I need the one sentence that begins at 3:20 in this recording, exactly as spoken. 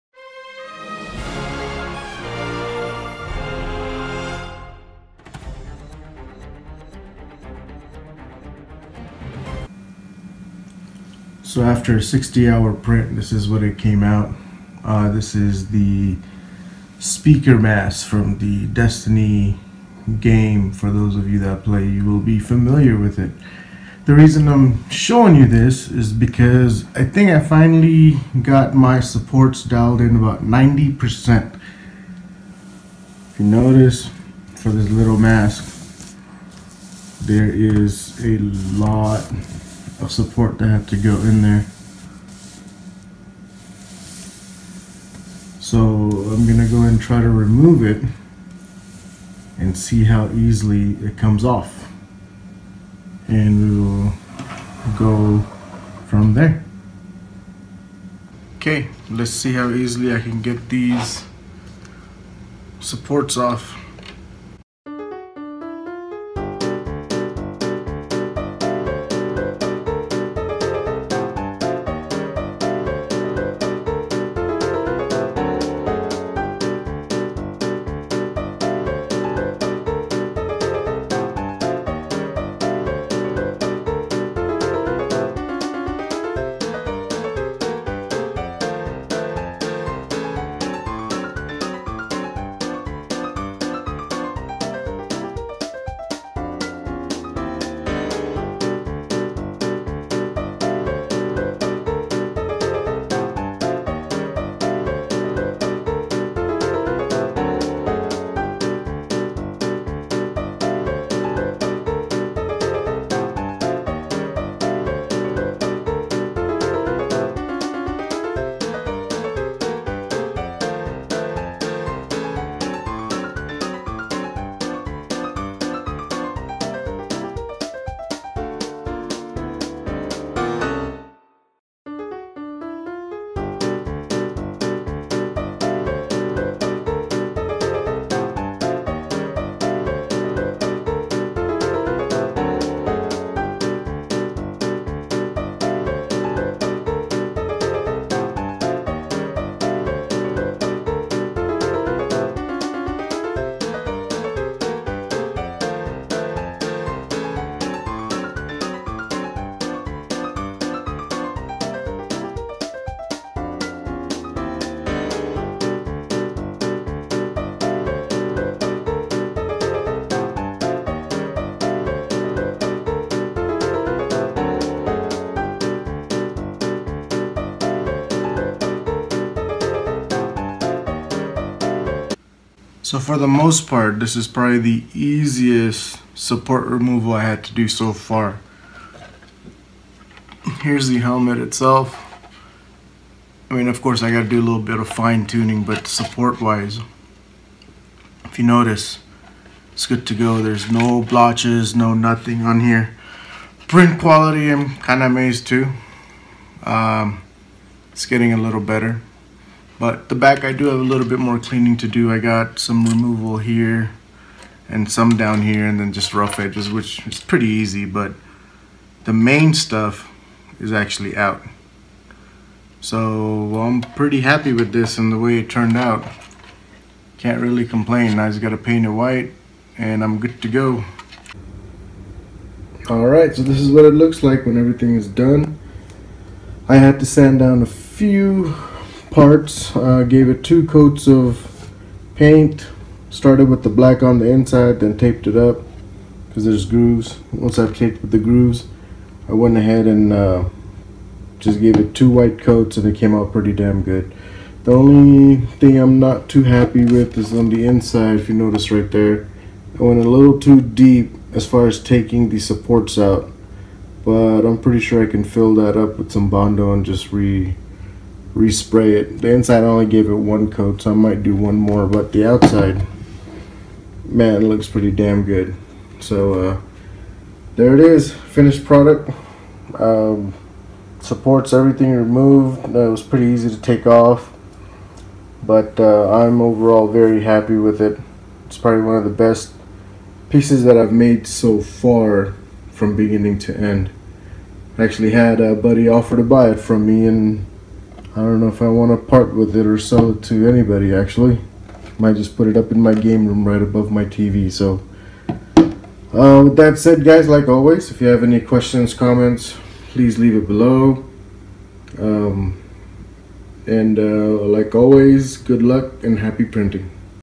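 There's no blotches, no nothing on here.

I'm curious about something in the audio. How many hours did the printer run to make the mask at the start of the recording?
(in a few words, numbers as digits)
60.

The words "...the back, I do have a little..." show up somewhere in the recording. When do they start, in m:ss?
3:30.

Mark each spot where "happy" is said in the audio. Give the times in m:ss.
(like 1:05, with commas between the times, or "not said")
3:44, 4:16, 4:47, 5:16.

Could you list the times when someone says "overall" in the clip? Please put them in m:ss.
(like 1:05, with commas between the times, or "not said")
4:46.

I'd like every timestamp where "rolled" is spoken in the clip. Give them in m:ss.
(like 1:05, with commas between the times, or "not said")
not said.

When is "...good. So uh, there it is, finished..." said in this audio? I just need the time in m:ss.
4:35.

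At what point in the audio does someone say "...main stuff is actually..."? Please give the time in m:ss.
3:39.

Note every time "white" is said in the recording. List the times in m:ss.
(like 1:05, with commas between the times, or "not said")
3:48, 4:12.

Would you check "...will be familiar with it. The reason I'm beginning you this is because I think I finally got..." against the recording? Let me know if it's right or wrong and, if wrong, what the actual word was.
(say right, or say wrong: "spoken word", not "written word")
wrong: "showing", not "beginning".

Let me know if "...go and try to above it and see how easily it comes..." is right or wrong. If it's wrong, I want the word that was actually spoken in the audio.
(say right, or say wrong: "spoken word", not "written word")
wrong: "remove", not "above".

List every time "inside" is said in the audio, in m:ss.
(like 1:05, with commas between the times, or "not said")
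4:04, 4:17, 4:29.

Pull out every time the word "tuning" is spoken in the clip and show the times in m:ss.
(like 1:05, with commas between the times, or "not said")
3:15.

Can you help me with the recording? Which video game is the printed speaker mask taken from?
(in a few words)
Destiny.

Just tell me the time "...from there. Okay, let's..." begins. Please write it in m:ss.
0:56.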